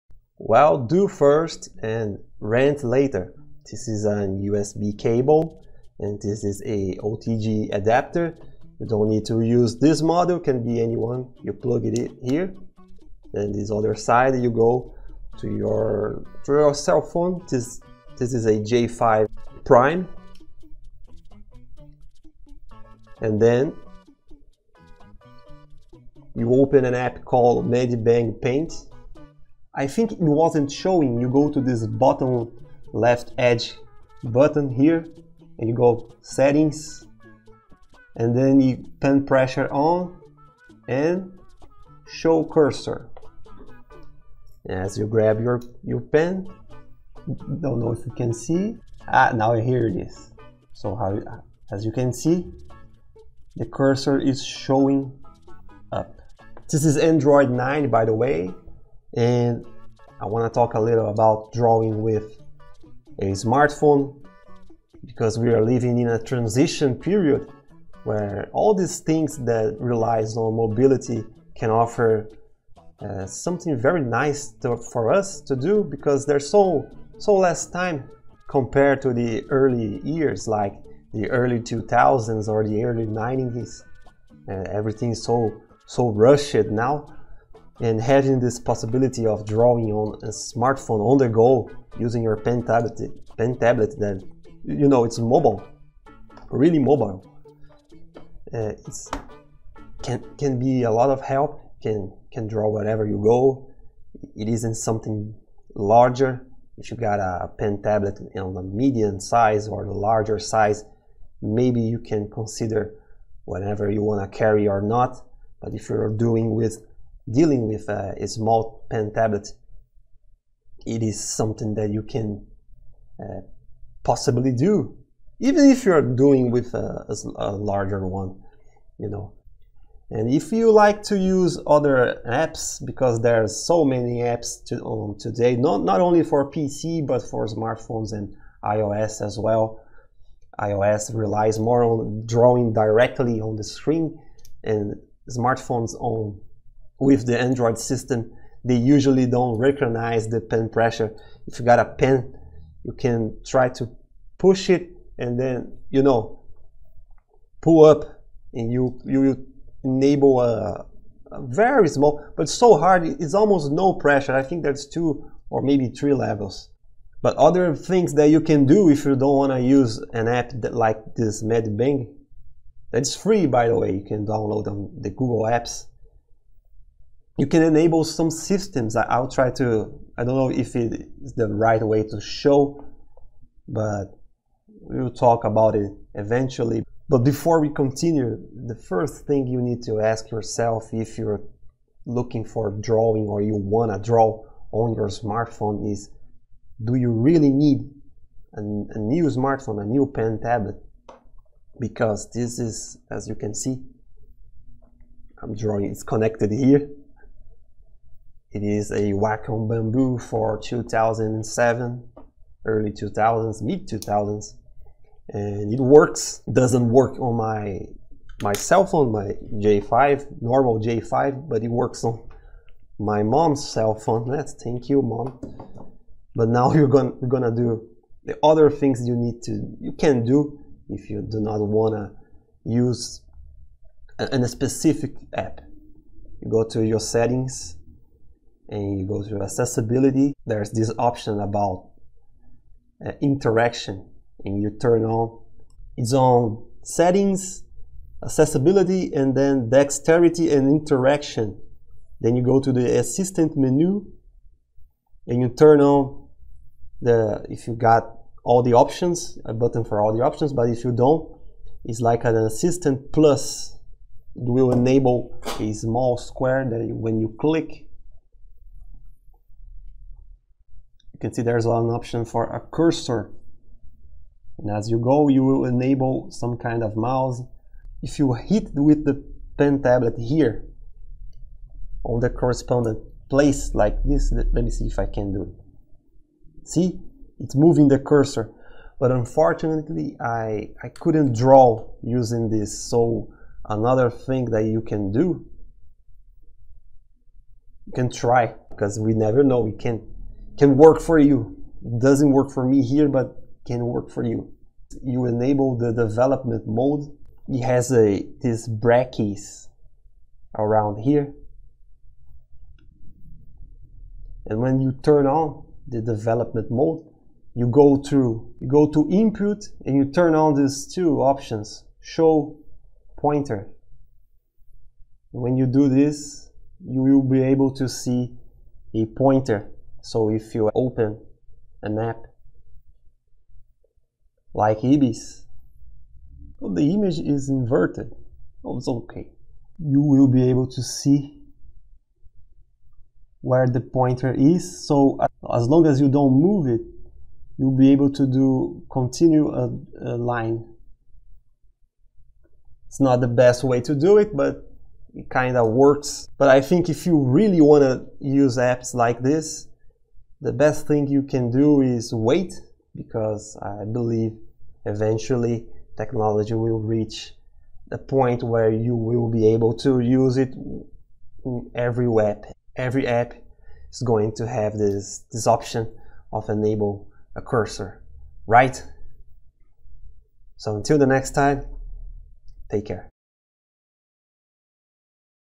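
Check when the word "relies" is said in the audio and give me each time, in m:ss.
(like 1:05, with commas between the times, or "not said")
1:09, 2:21.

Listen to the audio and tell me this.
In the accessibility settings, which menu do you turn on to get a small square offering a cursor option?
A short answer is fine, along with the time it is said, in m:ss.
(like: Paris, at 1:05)
assistant menu, at 4:12.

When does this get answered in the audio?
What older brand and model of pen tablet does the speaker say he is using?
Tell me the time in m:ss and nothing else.
3:29.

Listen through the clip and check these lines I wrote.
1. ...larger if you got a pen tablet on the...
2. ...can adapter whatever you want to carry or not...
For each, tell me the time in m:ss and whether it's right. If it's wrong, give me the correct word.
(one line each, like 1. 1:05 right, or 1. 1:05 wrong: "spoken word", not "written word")
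1. 1:45 right
2. 1:51 wrong: "consider", not "adapter".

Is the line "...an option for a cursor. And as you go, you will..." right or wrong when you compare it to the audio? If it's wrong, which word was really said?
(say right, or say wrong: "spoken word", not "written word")
right.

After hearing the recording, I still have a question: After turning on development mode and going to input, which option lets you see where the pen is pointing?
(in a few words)
show pointer.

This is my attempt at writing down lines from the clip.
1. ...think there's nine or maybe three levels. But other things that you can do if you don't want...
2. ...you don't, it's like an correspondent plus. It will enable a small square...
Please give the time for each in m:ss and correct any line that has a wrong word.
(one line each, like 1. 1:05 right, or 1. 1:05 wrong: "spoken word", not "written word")
1. 2:44 wrong: "two", not "nine"
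2. 4:20 wrong: "assistant", not "correspondent".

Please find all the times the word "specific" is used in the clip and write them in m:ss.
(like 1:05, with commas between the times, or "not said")
3:54.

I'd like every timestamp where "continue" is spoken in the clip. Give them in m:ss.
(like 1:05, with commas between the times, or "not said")
3:07, 5:48.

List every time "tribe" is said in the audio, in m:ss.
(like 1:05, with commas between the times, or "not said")
not said.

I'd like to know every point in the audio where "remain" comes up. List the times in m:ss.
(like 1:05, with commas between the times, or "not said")
not said.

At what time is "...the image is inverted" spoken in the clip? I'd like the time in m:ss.
5:36.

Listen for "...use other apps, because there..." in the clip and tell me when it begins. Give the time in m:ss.
2:11.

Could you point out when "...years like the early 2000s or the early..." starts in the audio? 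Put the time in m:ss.
1:20.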